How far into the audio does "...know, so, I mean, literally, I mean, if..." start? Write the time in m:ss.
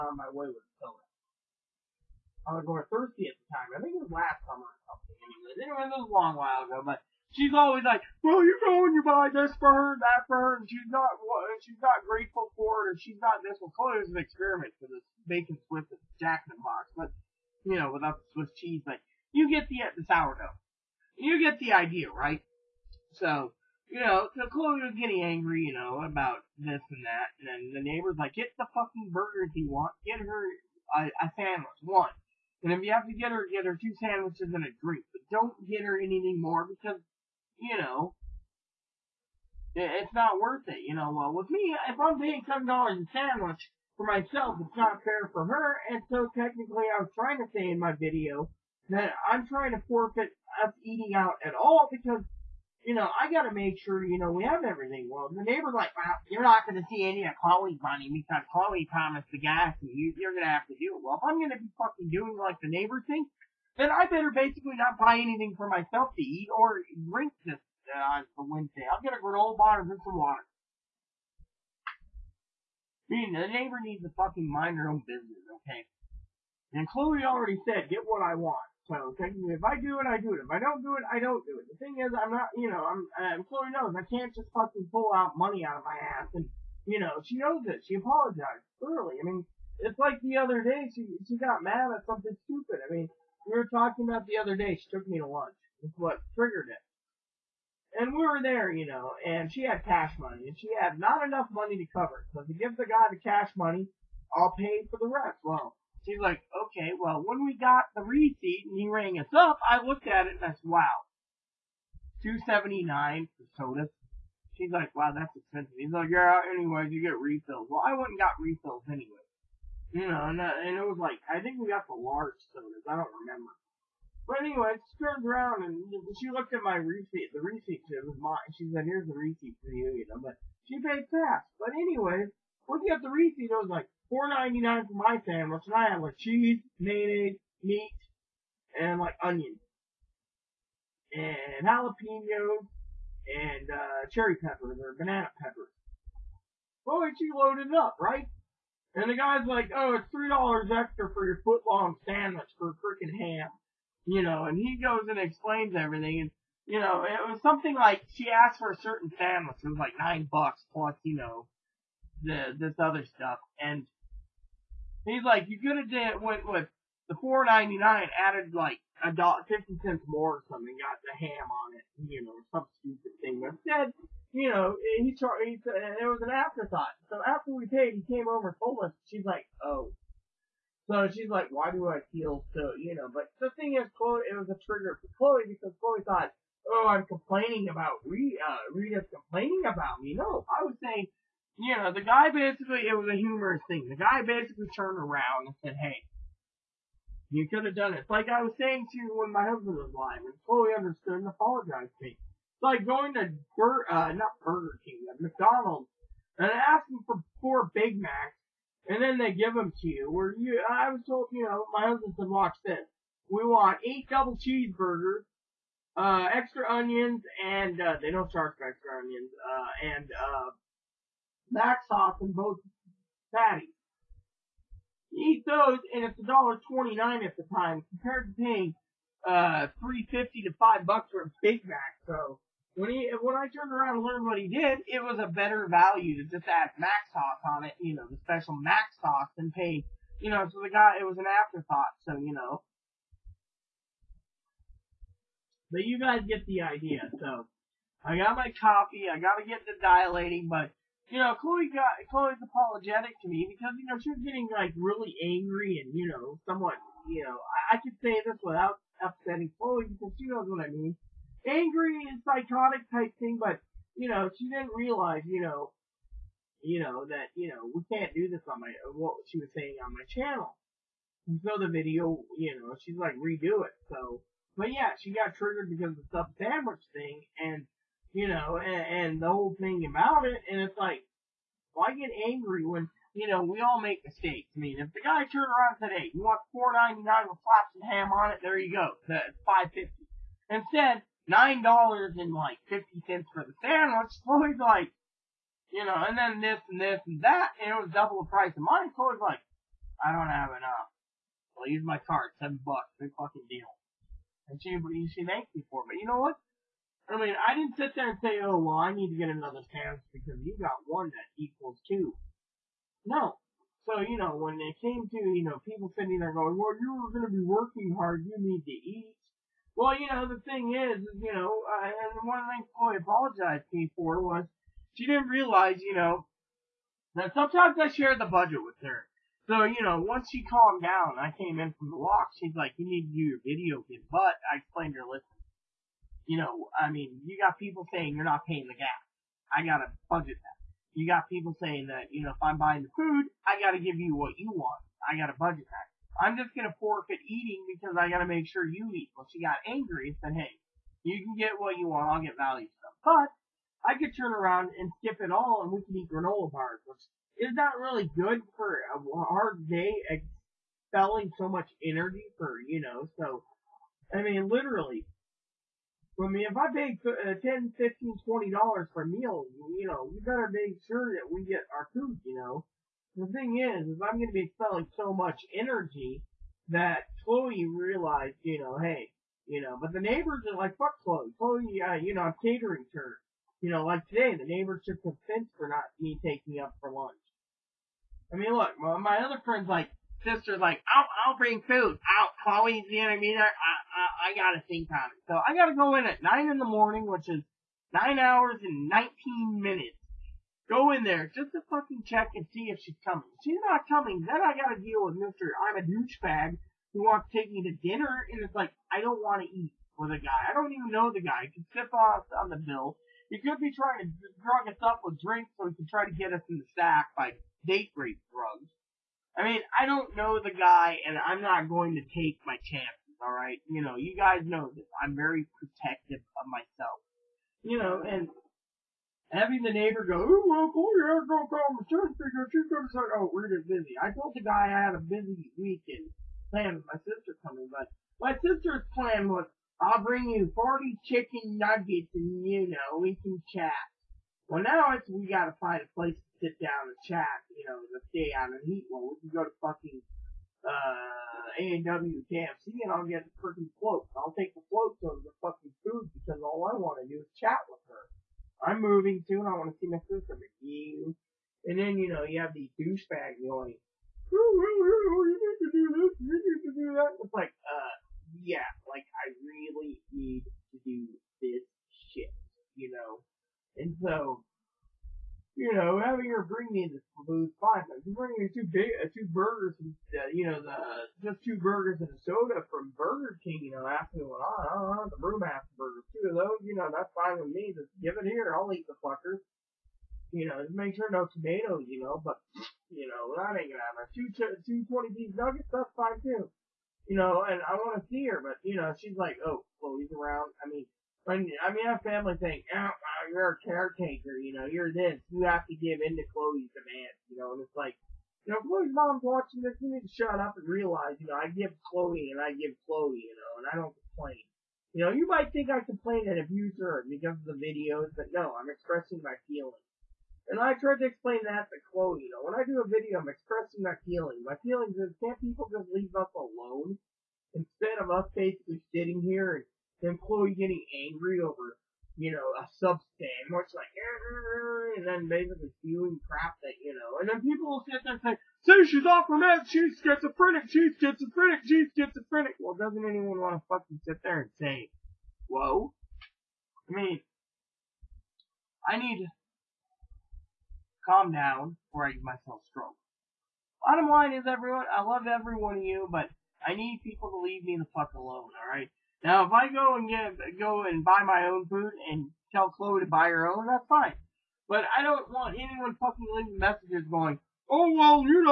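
6:02.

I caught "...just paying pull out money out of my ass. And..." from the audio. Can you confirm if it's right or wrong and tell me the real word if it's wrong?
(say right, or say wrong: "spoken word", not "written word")
wrong: "fucking", not "paying".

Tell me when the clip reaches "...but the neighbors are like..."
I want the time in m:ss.
6:19.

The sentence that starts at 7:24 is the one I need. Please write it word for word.
Well, now it's, we gotta find a place to sit down and chat, you know, to stay out of heat.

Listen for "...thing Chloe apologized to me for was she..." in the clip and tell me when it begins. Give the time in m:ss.
5:22.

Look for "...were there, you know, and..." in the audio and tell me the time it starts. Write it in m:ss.
1:38.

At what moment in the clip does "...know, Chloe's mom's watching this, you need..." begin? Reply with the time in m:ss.
8:28.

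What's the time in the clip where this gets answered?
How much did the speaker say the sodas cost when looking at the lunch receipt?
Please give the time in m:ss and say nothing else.
1:52.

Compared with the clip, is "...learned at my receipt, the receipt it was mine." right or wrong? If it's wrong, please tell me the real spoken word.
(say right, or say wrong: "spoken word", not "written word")
wrong: "looked", not "learned".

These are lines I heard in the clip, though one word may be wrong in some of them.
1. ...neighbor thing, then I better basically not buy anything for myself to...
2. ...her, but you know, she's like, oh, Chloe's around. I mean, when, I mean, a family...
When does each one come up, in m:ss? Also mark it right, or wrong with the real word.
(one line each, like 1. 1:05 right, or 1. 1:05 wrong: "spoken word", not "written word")
1. 1:02 right
2. 8:18 right.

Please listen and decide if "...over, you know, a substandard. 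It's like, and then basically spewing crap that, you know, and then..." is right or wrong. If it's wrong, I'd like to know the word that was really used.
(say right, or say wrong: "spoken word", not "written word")
right.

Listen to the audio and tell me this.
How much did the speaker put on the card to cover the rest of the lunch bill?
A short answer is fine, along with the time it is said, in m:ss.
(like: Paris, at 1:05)
$7, at 5:02.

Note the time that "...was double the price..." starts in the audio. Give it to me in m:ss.
4:57.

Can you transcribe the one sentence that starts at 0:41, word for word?
Well, with me, if I'm paying seven dollars a sandwich, for myself.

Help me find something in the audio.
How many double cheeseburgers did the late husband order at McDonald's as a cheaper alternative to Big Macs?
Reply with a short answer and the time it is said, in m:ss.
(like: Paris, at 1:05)
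8, at 3:33.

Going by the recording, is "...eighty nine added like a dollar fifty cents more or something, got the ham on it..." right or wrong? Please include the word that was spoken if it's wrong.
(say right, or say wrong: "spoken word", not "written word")
wrong: "ninety", not "eighty".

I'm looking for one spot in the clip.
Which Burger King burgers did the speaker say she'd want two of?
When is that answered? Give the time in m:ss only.
8:05.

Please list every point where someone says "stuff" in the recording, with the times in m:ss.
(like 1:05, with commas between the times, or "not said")
2:43, 5:52.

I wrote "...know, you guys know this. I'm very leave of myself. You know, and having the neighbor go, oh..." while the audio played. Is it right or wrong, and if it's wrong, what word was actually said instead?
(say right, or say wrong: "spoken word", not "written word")
wrong: "protective", not "leave".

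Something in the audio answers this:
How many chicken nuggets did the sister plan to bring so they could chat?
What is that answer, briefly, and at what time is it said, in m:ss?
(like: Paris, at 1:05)
40, at 7:20.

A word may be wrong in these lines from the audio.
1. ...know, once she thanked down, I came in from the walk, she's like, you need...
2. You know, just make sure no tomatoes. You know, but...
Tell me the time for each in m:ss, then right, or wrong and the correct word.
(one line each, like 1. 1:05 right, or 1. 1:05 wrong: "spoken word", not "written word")
1. 5:29 wrong: "calmed", not "thanked"
2. 8:10 right.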